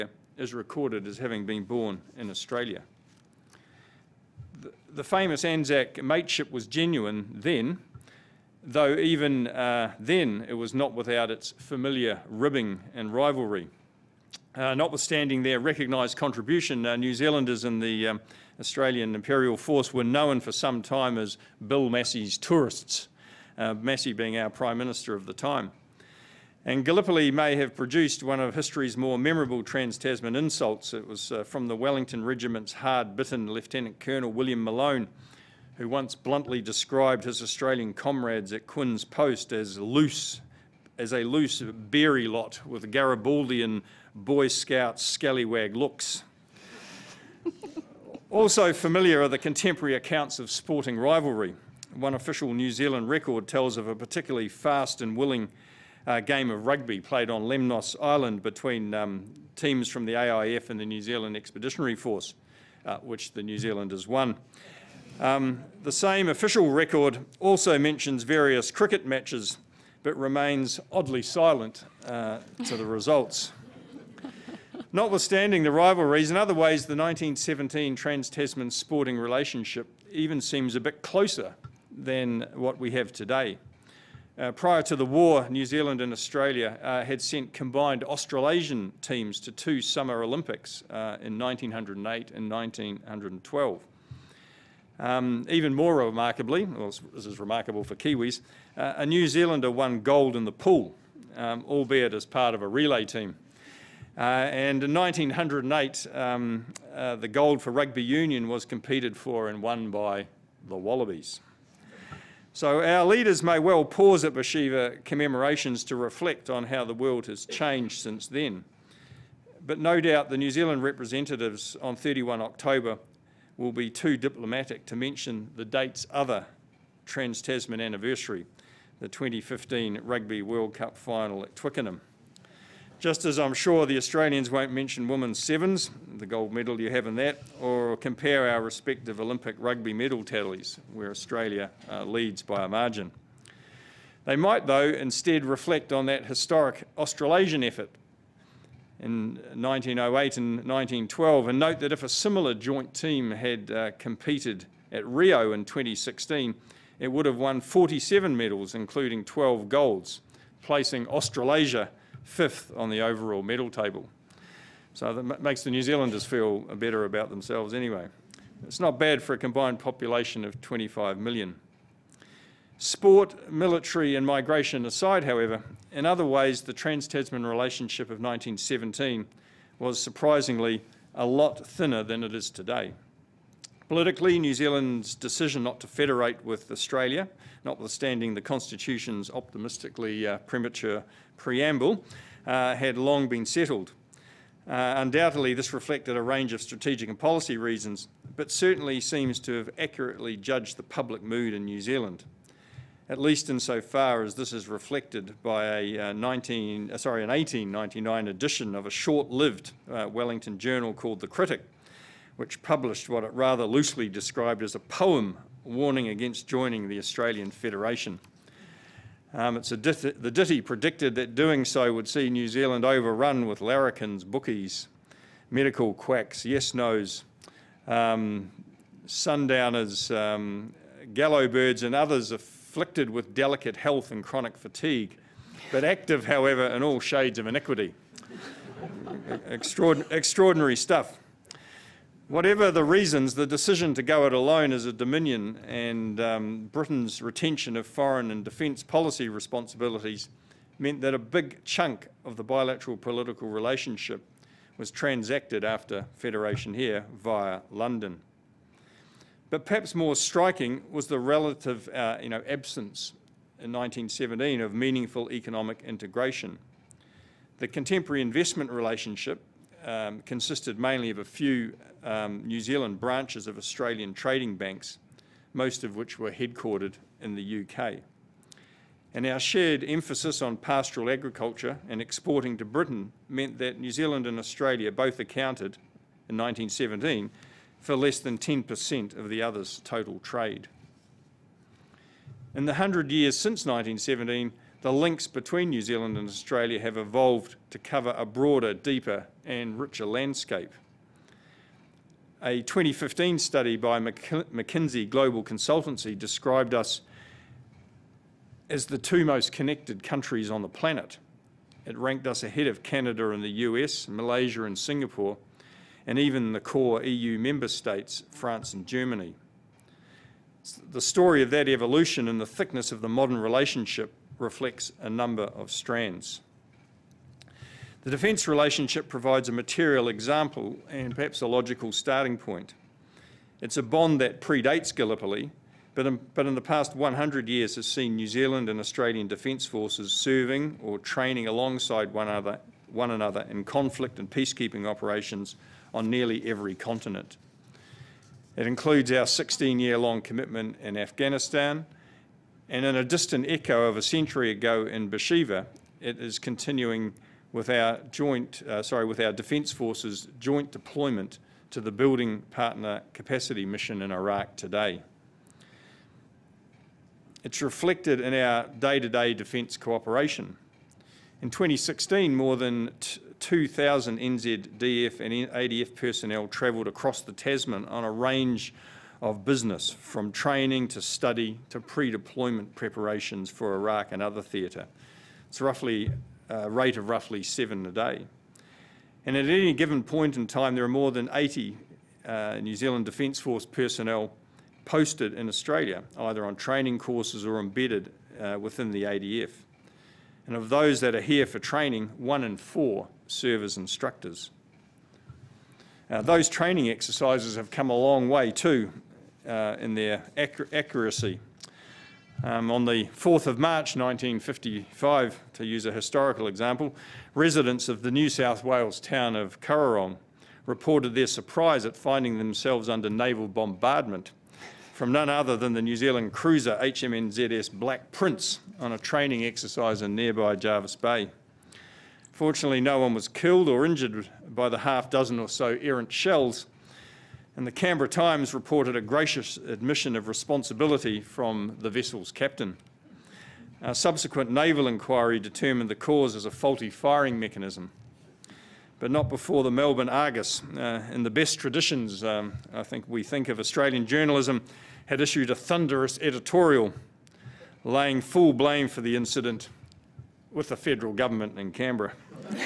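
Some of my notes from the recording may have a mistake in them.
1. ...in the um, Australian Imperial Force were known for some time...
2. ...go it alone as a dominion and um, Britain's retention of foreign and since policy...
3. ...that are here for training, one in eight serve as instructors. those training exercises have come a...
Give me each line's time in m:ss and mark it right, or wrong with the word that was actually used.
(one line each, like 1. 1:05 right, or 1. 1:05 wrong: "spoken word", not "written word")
1. 0:17 right
2. 4:04 wrong: "defence", not "since"
3. 6:41 wrong: "four", not "eight".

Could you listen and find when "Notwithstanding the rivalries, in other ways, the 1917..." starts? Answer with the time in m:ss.
1:14.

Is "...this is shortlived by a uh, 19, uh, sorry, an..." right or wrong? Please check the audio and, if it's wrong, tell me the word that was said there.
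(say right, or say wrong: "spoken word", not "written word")
wrong: "reflected", not "shortlived".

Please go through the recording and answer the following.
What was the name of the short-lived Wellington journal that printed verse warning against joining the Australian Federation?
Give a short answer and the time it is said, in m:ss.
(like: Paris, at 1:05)
The Critic, at 3:31.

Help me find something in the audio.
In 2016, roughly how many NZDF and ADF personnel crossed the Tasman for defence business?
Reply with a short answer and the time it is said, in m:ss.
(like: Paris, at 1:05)
more than 2,000, at 6:12.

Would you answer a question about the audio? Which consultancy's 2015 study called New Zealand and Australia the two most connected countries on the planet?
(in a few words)
McKinsey.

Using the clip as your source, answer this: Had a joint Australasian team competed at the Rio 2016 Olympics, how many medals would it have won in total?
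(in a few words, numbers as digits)
47.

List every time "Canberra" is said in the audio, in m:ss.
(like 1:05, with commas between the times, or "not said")
7:17, 7:41.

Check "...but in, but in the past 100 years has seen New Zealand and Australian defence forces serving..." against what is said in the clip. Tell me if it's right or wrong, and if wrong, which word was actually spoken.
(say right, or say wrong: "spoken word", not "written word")
right.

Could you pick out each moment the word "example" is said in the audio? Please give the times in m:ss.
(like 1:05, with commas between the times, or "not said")
5:30, 6:56.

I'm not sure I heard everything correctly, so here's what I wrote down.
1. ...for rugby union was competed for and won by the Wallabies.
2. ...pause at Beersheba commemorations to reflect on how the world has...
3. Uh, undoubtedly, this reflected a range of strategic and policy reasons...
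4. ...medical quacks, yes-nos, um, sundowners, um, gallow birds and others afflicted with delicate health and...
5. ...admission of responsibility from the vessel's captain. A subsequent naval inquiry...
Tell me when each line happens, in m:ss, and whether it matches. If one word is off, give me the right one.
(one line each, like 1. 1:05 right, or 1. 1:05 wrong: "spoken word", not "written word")
1. 1:47 right
2. 1:53 right
3. 3:14 right
4. 3:45 right
5. 7:19 right.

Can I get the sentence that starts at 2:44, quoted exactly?
So that makes the New Zealanders feel uh, better about themselves anyway.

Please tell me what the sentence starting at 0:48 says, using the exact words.
also familiar are the contemporary accounts of sporting rivalry.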